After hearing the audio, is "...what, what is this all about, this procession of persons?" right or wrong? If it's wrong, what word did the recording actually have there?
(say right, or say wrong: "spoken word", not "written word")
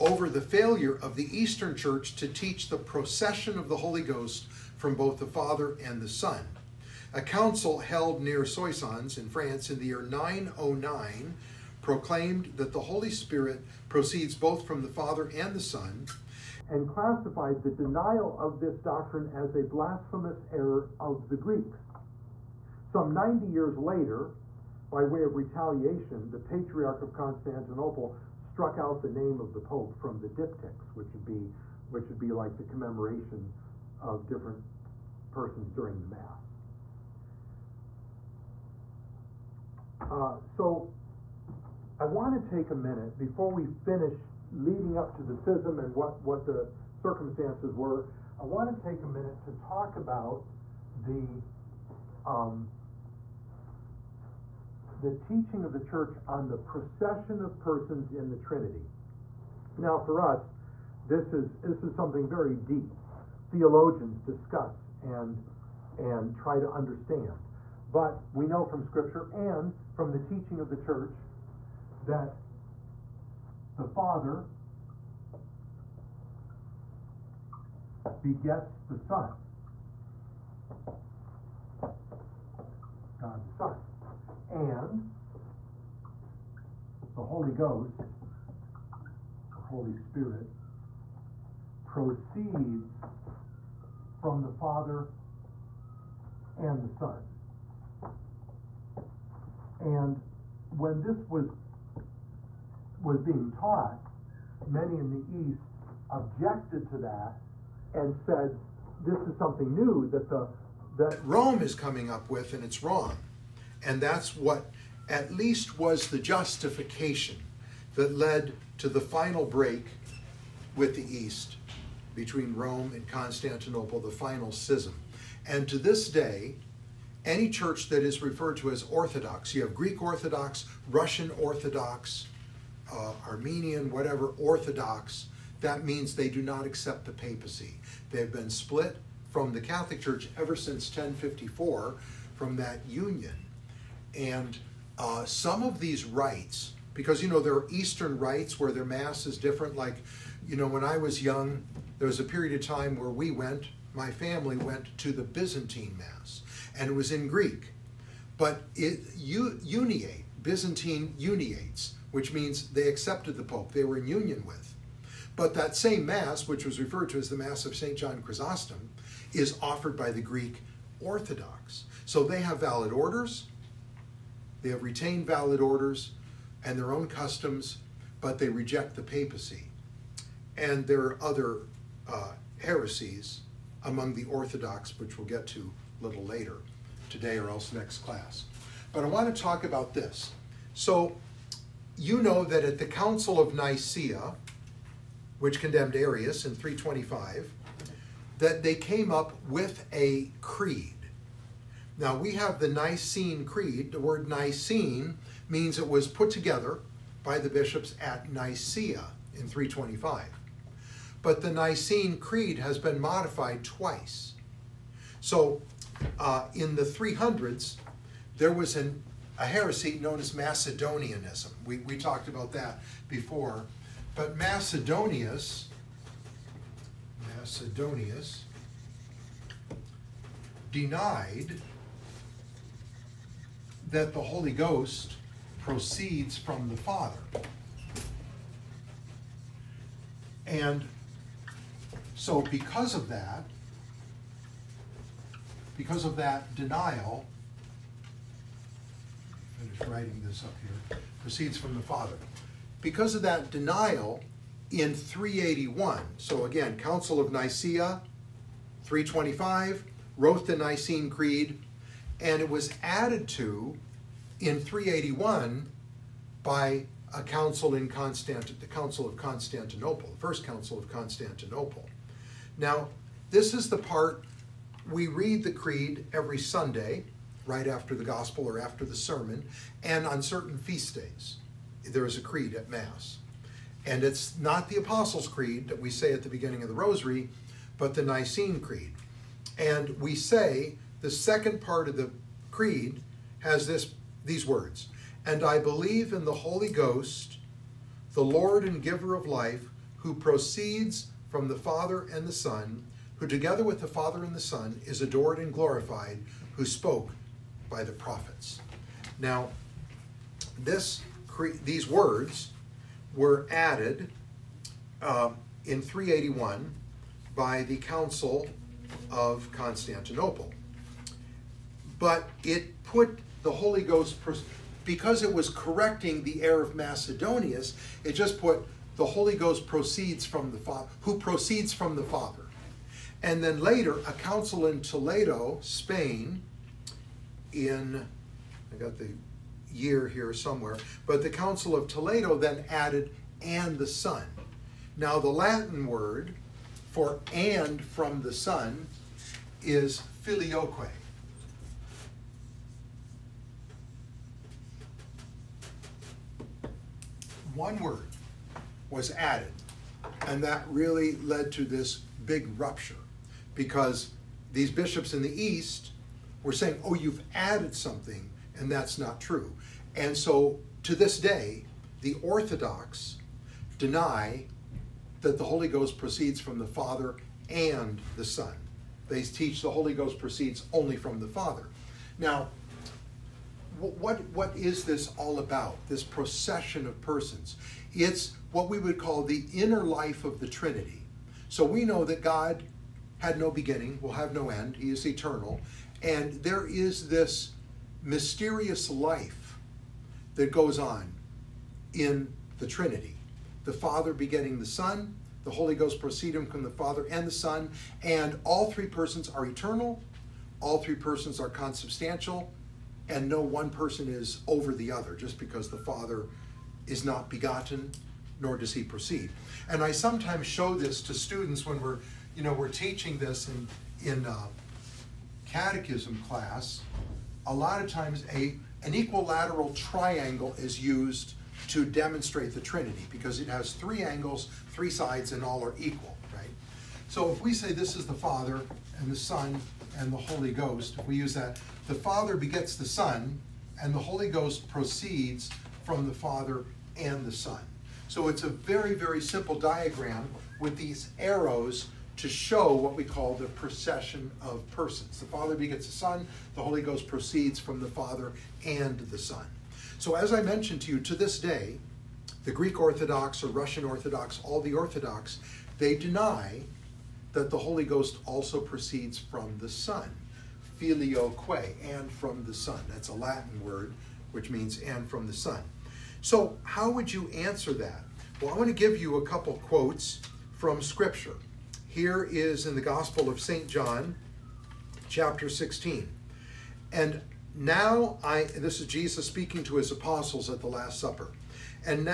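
right.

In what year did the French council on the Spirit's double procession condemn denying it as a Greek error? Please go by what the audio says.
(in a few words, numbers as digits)
909.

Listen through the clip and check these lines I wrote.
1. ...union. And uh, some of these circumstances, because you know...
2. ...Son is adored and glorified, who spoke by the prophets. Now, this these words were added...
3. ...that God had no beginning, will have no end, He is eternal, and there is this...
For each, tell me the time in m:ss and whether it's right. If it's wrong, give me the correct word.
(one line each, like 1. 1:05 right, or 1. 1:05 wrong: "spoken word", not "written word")
1. 2:22 wrong: "rites", not "circumstances"
2. 5:04 right
3. 6:32 right.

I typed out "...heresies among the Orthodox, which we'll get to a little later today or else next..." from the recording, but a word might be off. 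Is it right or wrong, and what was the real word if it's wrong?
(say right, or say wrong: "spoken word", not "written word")
right.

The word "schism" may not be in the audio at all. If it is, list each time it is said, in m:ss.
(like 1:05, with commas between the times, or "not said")
0:45, 2:04.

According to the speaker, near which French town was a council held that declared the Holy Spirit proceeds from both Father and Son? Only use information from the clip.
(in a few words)
Soissons.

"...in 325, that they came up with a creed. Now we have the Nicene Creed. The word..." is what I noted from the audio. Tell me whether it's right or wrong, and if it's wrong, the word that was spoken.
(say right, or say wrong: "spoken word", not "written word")
right.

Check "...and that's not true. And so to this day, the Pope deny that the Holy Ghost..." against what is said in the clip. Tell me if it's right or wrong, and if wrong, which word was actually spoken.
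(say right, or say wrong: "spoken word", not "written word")
wrong: "Orthodox", not "Pope".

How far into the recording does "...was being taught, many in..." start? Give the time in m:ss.
1:43.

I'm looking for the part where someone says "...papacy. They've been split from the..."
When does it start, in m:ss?
2:17.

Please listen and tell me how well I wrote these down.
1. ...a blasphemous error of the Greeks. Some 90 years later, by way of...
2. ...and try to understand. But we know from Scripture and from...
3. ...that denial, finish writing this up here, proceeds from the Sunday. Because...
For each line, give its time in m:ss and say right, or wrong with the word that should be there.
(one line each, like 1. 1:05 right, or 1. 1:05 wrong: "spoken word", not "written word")
1. 0:19 right
2. 1:05 right
3. 4:06 wrong: "Father", not "Sunday".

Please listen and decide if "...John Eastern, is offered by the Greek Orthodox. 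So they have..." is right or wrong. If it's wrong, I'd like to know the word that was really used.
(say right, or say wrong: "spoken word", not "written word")
wrong: "Chrysostom", not "Eastern".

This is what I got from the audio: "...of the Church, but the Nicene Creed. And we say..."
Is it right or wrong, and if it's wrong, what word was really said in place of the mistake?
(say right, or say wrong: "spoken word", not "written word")
wrong: "Rosary", not "Church".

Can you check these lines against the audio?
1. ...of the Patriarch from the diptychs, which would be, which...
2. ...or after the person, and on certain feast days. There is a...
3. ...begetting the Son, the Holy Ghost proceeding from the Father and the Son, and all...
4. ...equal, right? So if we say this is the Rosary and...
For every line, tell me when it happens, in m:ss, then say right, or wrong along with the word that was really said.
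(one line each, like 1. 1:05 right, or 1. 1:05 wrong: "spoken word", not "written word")
1. 0:29 wrong: "Pope", not "Patriarch"
2. 4:38 wrong: "sermon", not "person"
3. 6:44 right
4. 7:15 wrong: "Father", not "Rosary".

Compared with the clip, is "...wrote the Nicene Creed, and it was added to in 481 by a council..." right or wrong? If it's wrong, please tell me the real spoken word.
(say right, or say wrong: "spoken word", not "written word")
wrong: "381", not "481".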